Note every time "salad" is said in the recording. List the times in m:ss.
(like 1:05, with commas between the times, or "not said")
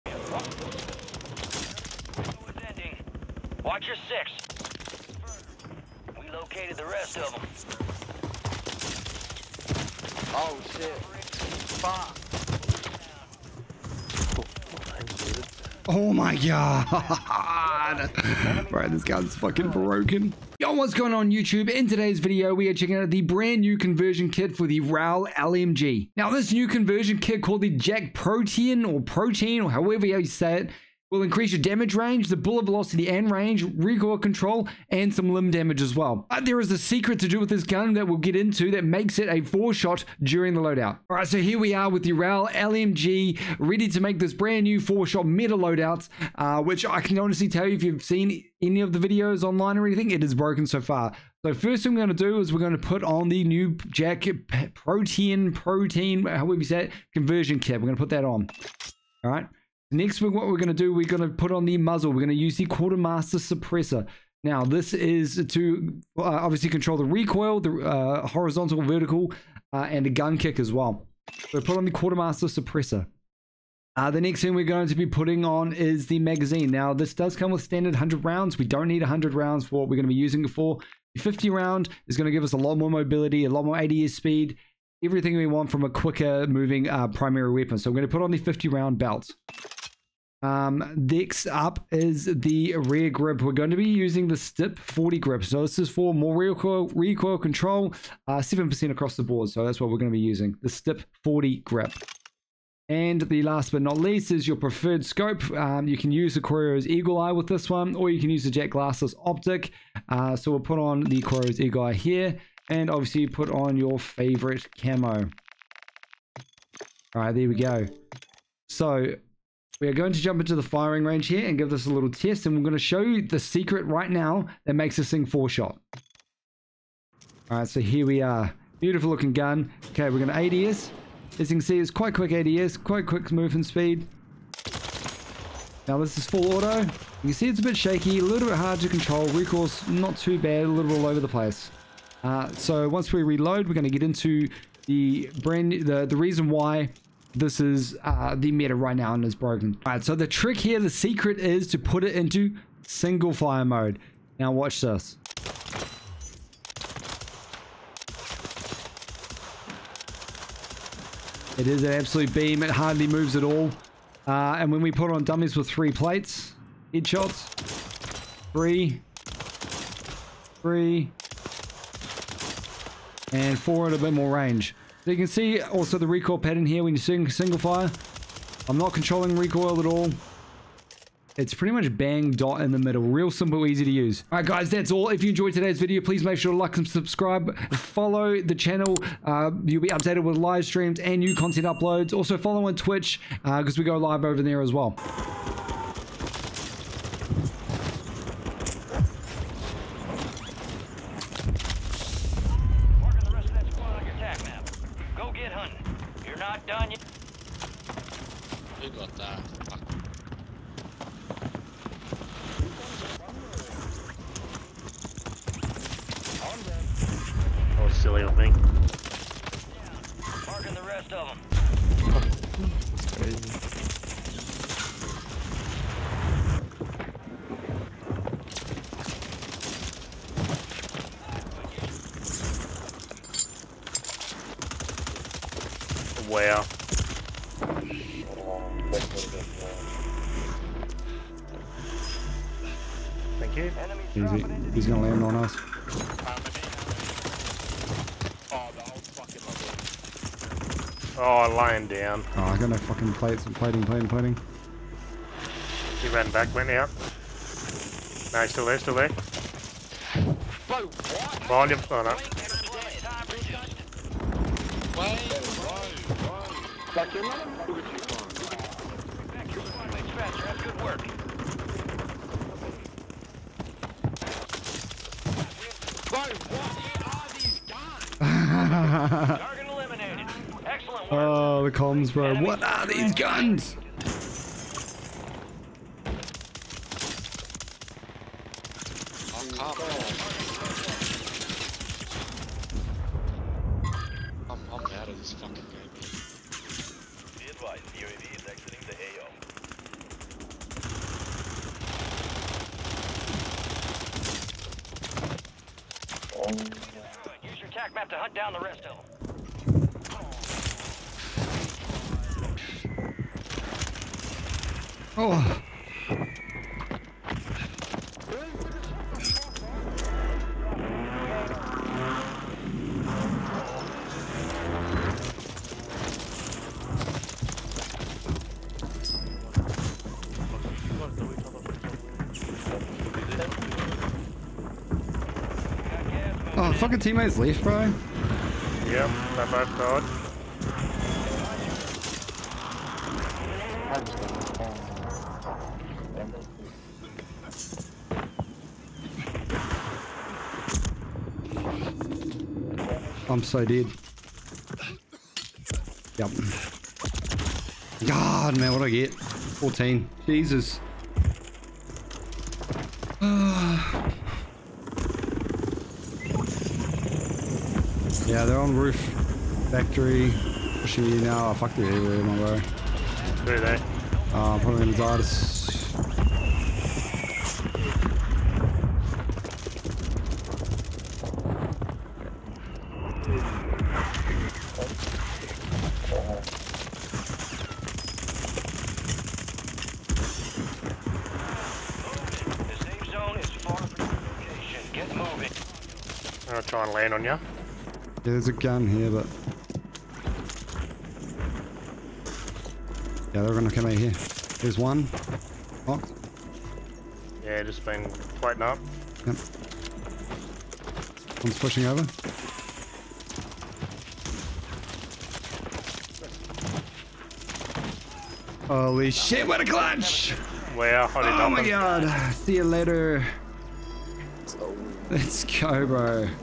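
not said.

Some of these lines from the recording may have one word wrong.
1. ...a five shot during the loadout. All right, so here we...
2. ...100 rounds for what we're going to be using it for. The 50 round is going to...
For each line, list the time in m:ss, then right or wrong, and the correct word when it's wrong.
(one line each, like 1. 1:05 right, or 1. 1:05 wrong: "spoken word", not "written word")
1. 0:39 wrong: "four", not "five"
2. 1:19 right.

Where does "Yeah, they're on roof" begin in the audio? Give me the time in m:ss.
6:08.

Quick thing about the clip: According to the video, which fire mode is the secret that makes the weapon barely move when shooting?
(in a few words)
Single fire mode.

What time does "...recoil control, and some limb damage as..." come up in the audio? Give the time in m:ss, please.
0:33.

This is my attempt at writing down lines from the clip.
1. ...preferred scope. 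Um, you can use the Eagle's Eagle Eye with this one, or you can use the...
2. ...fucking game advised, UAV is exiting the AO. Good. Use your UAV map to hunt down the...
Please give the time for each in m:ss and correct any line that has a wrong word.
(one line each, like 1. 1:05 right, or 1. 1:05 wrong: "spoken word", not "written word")
1. 1:44 wrong: "Corio", not "Eagle"
2. 4:55 wrong: "TAC", not "UAV".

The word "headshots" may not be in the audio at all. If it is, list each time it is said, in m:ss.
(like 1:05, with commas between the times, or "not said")
2:46.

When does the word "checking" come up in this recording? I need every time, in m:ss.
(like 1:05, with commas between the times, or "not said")
0:22.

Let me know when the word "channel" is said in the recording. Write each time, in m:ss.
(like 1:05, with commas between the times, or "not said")
3:08.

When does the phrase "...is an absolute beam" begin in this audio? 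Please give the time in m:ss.
2:41.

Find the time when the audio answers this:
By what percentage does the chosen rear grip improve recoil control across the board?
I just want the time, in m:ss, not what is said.
1:38.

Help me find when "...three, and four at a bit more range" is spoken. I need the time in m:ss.
2:50.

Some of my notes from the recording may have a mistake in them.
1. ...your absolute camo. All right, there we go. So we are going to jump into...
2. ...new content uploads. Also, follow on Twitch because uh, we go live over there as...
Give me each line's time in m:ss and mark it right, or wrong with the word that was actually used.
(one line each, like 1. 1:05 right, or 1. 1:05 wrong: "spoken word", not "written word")
1. 1:53 wrong: "favorite", not "absolute"
2. 3:11 right.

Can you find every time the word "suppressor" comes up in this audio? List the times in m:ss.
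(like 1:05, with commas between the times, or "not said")
1:03, 1:12.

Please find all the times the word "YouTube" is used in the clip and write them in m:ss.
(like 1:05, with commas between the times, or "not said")
0:21.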